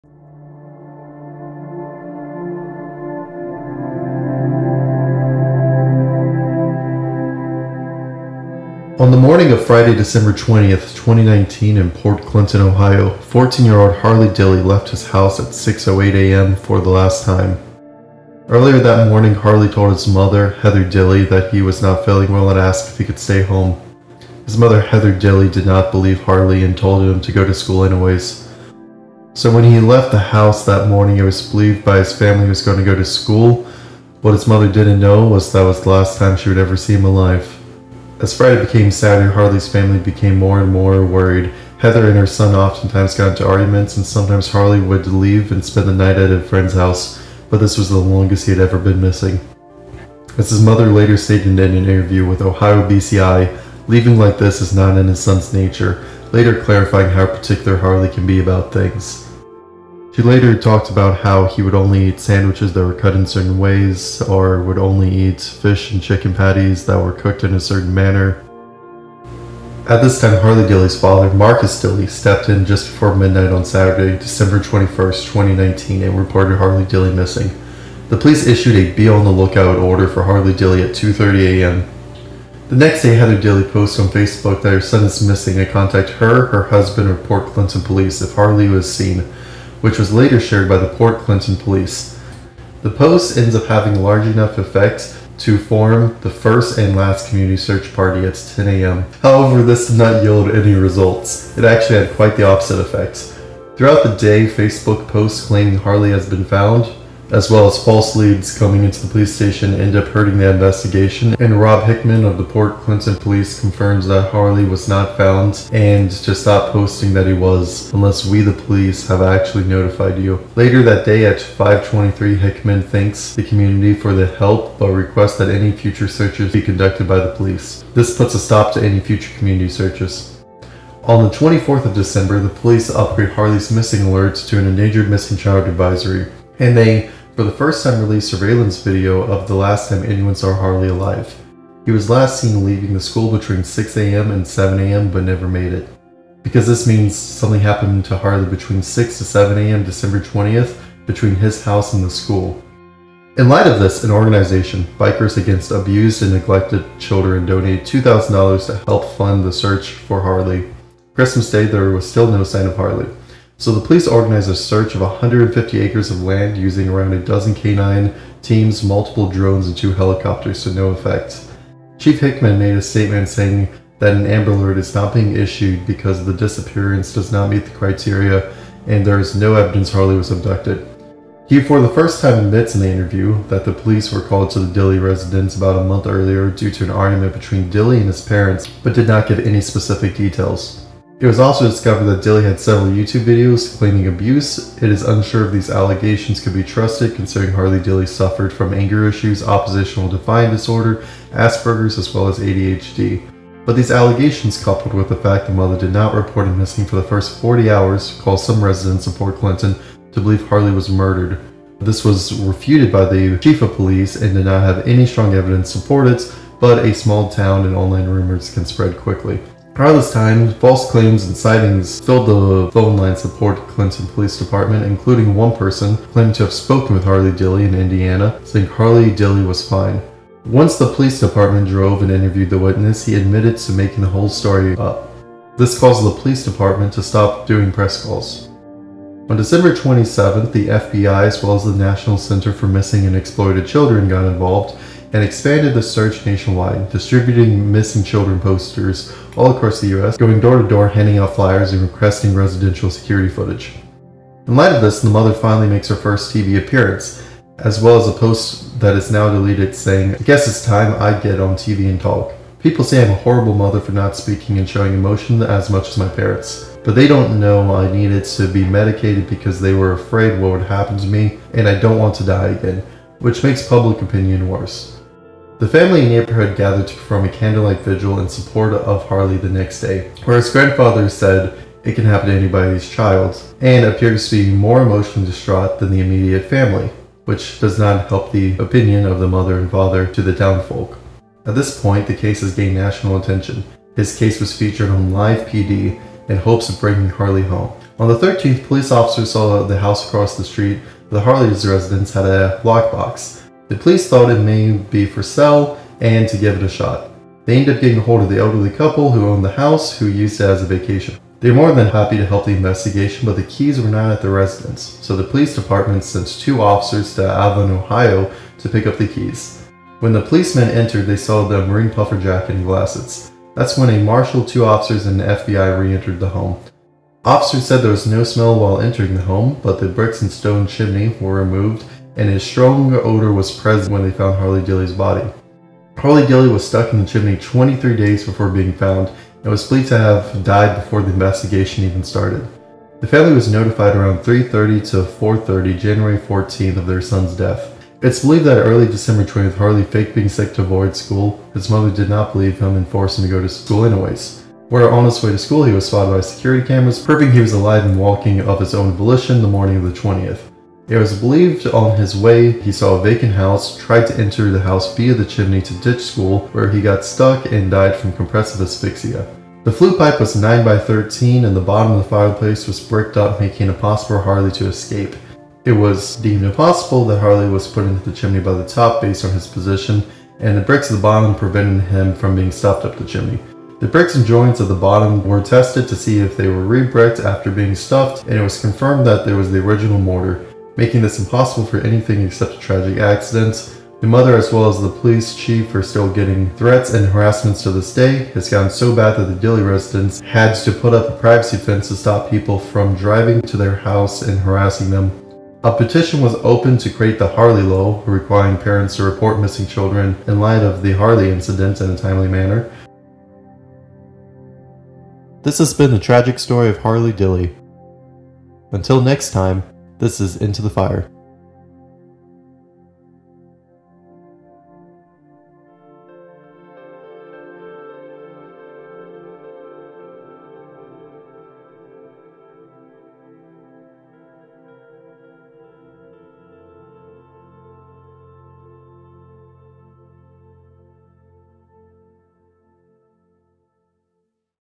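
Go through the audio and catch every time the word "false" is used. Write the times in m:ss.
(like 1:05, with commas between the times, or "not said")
1:47, 3:40.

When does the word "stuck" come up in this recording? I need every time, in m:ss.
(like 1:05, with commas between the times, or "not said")
5:36, 6:07.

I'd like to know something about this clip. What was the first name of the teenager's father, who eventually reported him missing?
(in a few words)
Marcus.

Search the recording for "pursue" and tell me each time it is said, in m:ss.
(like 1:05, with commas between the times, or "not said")
not said.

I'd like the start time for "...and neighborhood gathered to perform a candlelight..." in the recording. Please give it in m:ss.
4:35.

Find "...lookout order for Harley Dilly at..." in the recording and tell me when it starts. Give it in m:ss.
1:19.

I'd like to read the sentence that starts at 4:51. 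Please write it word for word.
At this point, the case has gained national attention.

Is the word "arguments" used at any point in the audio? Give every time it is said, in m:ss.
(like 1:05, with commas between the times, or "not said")
0:43, 3:06.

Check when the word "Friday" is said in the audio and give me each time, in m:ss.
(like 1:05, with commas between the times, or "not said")
0:09, 0:38.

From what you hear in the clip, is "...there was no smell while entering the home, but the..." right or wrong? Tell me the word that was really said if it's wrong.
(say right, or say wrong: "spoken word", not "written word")
right.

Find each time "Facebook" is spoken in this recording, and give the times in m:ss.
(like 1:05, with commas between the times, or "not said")
1:24, 1:44.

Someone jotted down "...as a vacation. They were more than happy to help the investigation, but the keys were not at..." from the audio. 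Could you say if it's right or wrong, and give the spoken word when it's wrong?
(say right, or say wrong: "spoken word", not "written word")
right.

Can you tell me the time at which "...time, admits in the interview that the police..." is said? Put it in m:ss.
3:02.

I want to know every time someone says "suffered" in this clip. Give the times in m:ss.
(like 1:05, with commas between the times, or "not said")
3:18.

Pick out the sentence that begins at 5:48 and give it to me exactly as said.
It's believed that early December 20th, Harley faked being sick to avoid school.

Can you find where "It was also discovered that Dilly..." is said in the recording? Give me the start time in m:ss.
3:11.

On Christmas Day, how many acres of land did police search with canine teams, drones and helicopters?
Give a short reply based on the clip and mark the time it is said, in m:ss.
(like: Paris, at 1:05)
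150, at 2:45.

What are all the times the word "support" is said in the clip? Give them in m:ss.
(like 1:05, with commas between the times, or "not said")
3:35, 4:38.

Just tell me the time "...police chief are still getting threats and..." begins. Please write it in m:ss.
6:34.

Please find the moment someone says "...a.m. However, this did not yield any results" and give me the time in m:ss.
1:38.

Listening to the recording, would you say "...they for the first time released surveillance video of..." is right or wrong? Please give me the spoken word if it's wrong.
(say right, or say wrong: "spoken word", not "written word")
right.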